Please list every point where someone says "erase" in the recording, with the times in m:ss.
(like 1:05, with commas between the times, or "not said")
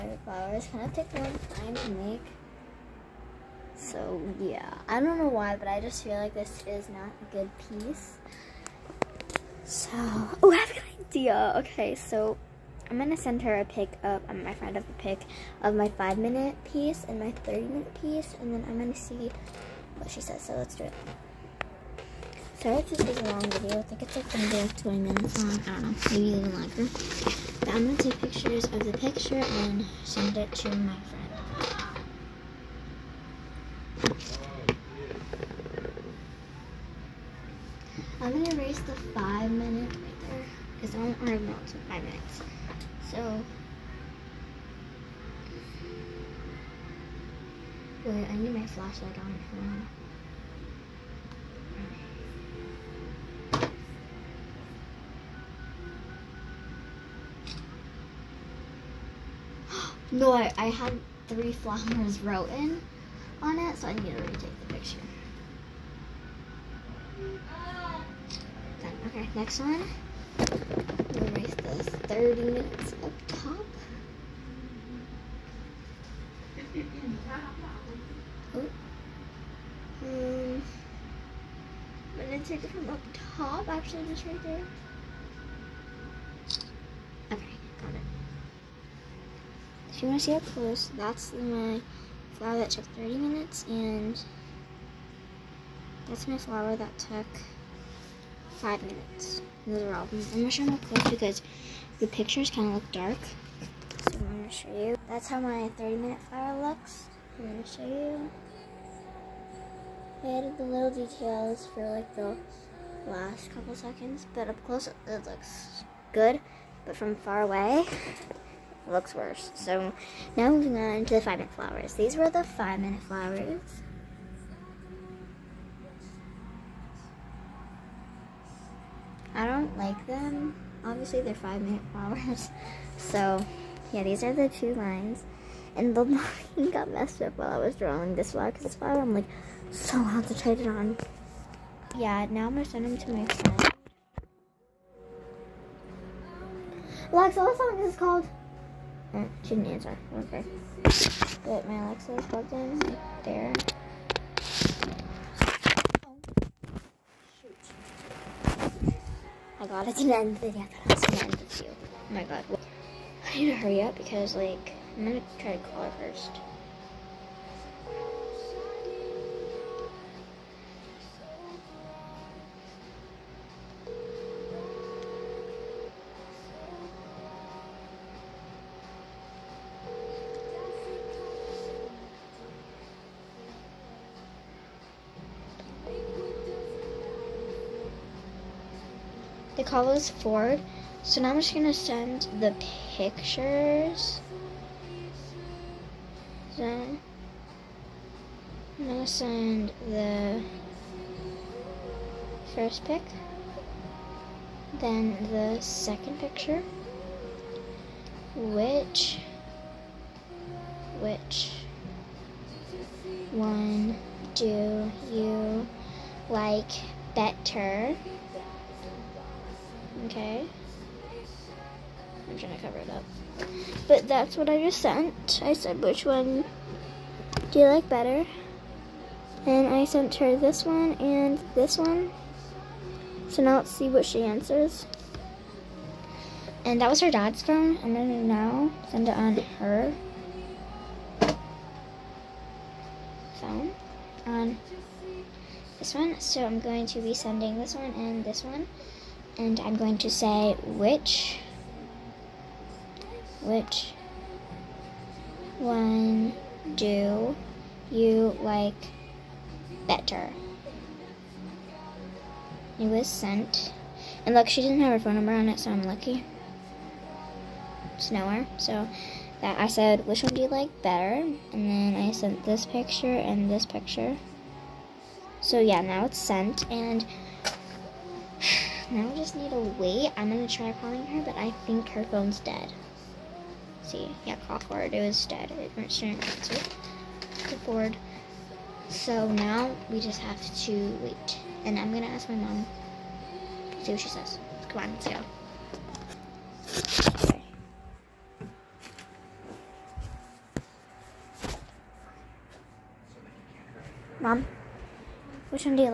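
0:38, 1:10.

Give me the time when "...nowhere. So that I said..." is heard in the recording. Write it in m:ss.
4:28.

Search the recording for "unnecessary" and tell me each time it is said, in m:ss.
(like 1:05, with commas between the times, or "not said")
not said.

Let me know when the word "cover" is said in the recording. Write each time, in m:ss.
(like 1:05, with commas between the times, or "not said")
3:42.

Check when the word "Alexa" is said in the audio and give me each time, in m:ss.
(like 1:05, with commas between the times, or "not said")
2:27, 2:31.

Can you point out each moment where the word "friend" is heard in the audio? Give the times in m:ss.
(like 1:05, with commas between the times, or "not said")
0:14, 0:31, 2:23.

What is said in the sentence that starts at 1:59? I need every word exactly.
So now moving on to the five minute flowers.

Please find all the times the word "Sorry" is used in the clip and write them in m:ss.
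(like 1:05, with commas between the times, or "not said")
0:22.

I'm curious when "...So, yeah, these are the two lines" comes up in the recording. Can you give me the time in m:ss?
2:12.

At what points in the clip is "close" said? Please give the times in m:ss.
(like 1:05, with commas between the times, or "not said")
1:30, 1:40, 1:54.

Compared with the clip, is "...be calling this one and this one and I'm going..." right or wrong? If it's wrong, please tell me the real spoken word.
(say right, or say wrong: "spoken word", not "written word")
wrong: "sending", not "calling".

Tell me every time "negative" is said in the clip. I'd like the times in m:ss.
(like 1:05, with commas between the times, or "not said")
not said.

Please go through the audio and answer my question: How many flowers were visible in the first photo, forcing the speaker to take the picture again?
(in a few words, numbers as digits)
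3.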